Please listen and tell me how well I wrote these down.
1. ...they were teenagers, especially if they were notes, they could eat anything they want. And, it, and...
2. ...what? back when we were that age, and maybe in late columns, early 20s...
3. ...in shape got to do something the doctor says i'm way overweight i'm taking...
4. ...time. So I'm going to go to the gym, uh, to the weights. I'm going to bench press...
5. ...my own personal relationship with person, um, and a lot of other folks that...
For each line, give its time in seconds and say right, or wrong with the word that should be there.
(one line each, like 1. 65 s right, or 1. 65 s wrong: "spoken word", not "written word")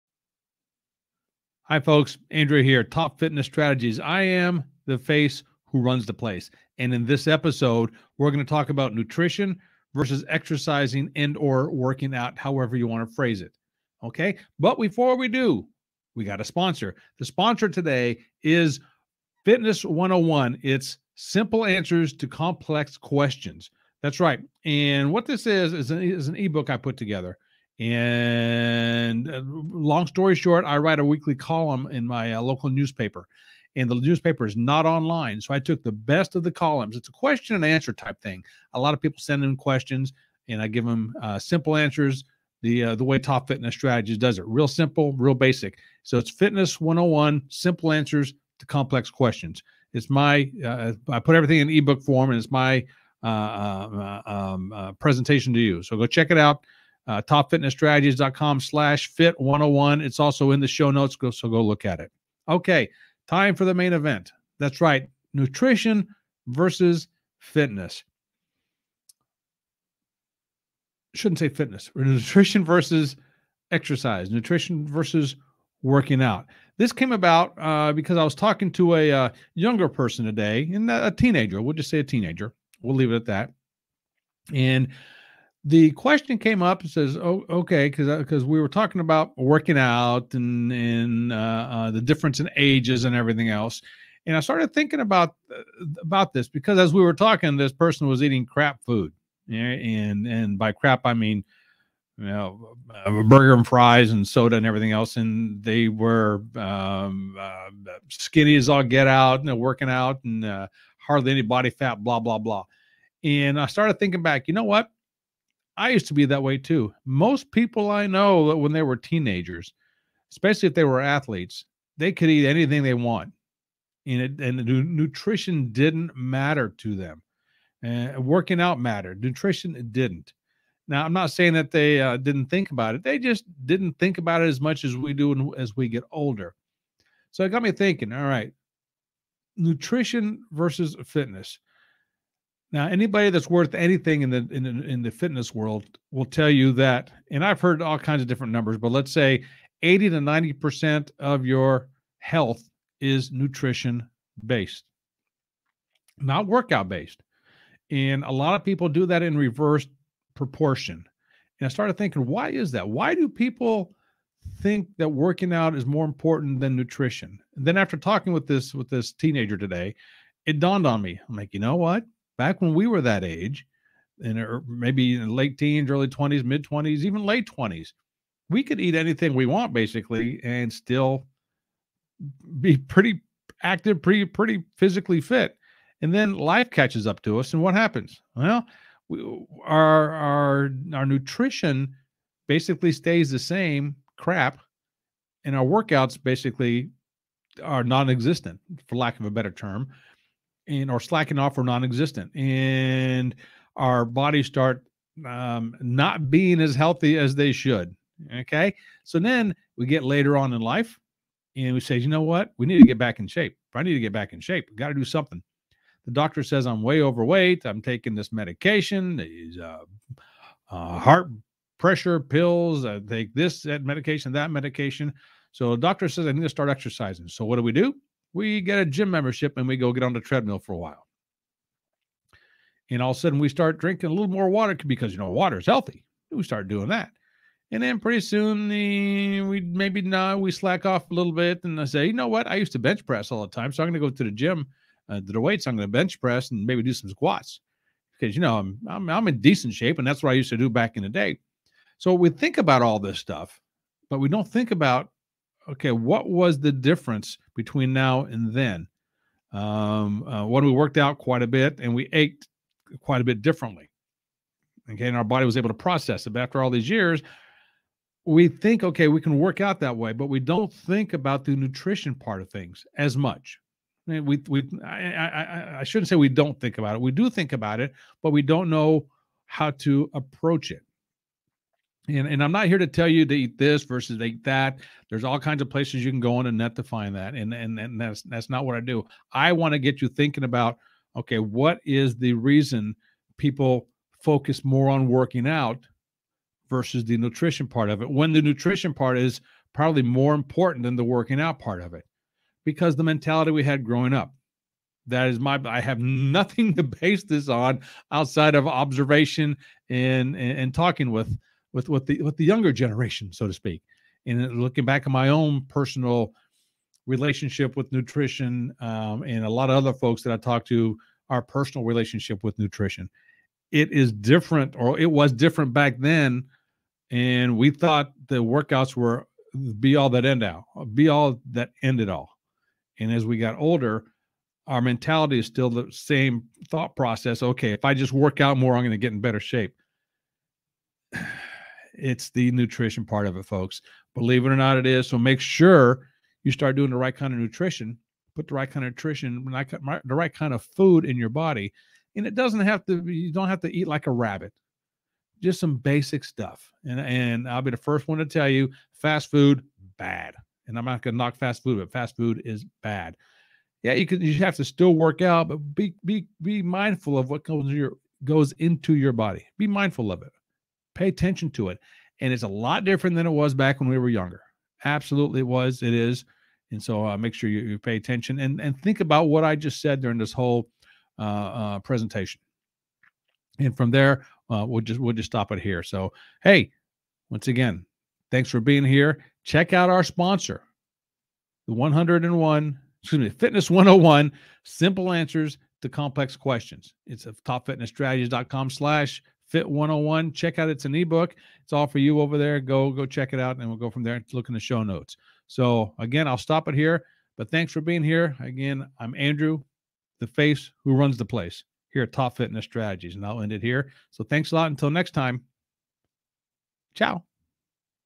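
1. 118 s wrong: "athletes", not "notes"
2. 171 s wrong: "teens", not "columns"
3. 214 s right
4. 243 s right
5. 315 s wrong: "nutrition", not "person".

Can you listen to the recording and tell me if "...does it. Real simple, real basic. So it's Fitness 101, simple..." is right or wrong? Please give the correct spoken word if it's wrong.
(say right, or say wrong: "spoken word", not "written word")
right.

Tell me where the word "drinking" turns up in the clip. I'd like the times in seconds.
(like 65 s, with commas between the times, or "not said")
233 s.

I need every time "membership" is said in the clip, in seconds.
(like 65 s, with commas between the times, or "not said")
229 s.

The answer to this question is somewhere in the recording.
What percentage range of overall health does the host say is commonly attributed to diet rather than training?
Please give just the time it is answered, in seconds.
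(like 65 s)
149 s.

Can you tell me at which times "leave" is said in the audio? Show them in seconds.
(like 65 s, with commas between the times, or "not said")
82 s.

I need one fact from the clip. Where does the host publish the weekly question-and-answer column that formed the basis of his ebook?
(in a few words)
local newspaper.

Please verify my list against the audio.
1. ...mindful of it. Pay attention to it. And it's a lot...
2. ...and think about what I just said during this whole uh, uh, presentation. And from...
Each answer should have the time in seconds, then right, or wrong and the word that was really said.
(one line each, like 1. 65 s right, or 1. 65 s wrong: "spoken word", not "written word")
1. 369 s right
2. 378 s right.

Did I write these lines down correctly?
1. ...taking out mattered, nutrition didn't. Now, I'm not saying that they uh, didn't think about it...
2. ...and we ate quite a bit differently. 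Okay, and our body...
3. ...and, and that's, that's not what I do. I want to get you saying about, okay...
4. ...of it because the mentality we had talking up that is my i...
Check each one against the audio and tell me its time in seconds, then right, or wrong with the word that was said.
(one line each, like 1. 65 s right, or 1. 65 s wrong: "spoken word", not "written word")
1. 128 s wrong: "working", not "taking"
2. 261 s right
3. 287 s wrong: "thinking", not "saying"
4. 301 s wrong: "growing", not "talking".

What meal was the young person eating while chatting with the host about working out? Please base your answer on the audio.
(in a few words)
burger and fries.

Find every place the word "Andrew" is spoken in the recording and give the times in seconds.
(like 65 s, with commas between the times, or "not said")
2 s, 409 s.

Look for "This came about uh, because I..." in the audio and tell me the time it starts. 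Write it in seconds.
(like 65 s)
76 s.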